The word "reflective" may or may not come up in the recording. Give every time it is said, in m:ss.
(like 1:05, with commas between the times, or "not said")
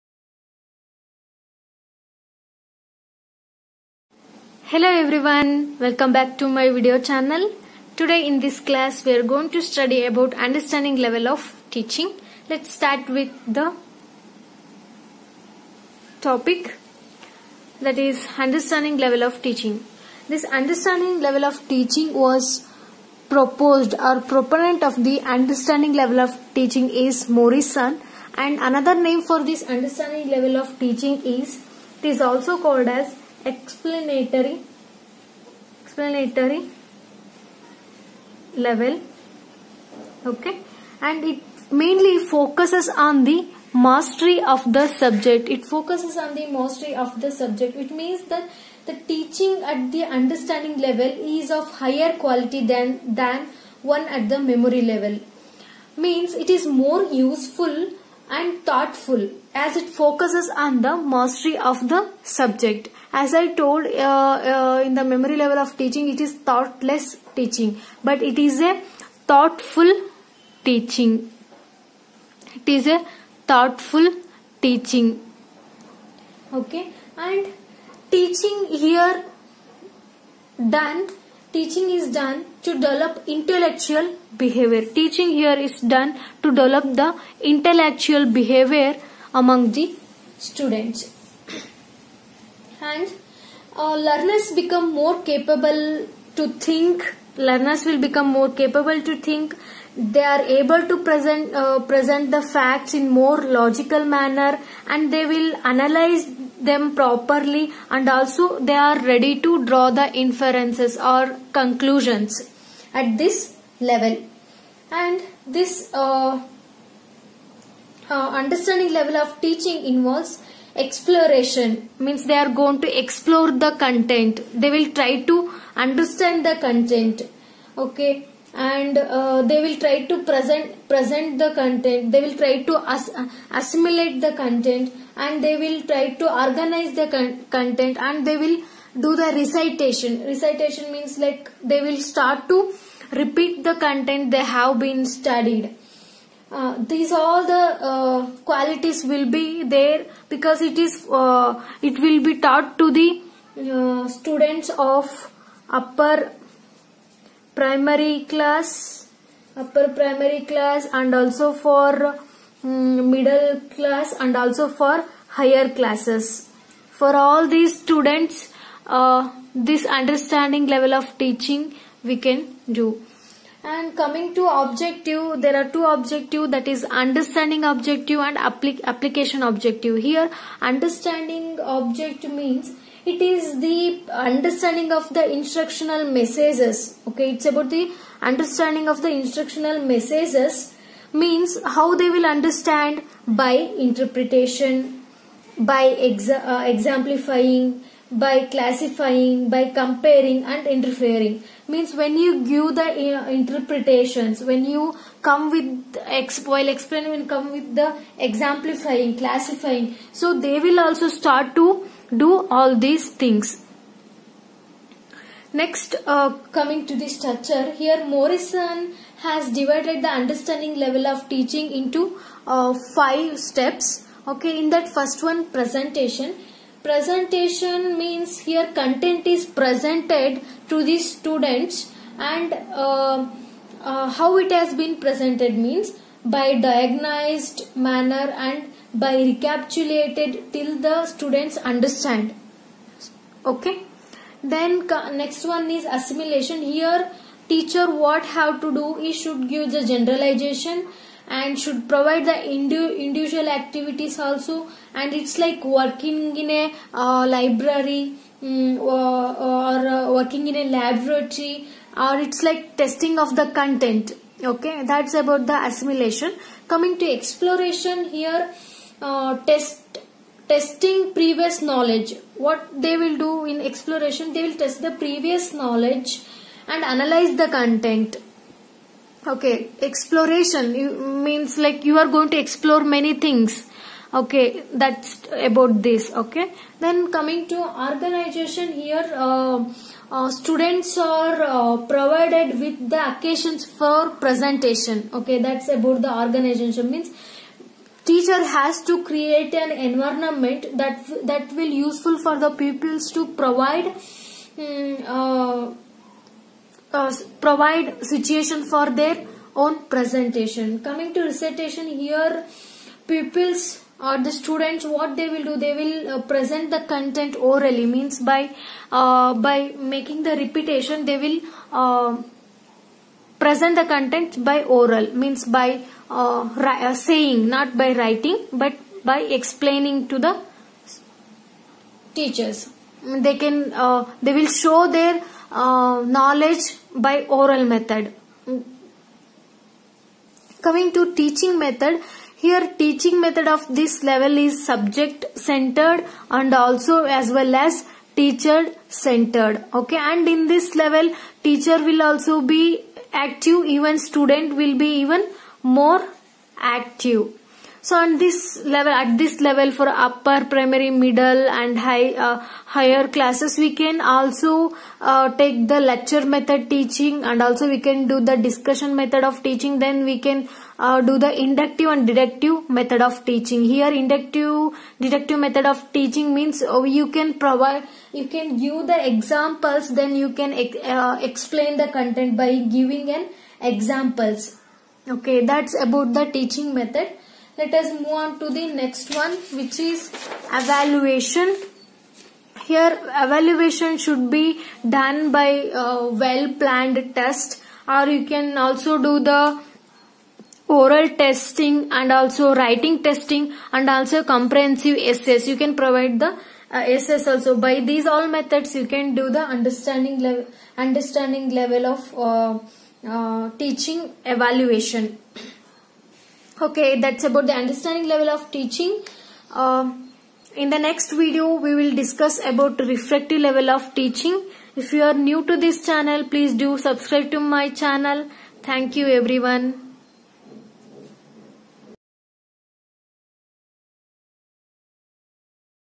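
7:02.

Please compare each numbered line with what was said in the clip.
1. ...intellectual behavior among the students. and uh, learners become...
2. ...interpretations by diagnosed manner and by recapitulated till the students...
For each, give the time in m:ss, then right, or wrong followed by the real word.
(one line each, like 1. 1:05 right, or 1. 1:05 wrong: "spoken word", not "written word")
1. 1:27 right
2. 3:55 wrong: "means", not "interpretations".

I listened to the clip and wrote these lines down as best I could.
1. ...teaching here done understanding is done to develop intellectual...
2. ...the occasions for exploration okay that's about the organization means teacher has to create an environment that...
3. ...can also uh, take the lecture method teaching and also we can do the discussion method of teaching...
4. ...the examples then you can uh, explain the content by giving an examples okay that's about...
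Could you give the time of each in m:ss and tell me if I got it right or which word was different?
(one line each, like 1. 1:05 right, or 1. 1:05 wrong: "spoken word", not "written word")
1. 1:18 wrong: "teaching", not "understanding"
2. 4:52 wrong: "presentation", not "exploration"
3. 6:03 right
4. 6:18 right.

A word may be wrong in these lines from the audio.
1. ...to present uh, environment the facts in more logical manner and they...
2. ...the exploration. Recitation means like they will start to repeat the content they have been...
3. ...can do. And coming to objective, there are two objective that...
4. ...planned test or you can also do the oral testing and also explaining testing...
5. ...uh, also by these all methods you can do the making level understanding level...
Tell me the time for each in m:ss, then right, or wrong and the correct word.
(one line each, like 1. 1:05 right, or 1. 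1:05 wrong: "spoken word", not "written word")
1. 1:40 wrong: "present", not "environment"
2. 2:19 wrong: "recitation", not "exploration"
3. 2:52 right
4. 6:36 wrong: "writing", not "explaining"
5. 6:46 wrong: "understanding", not "making".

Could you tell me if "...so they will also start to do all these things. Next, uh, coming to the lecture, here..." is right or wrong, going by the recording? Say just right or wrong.
wrong.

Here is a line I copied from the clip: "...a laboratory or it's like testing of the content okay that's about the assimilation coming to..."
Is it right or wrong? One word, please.
right.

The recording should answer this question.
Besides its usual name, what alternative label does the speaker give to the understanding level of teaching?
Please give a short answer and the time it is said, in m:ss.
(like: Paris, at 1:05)
Explanatory level, at 0:35.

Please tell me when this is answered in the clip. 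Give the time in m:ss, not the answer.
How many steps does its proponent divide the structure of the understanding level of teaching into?
3:42.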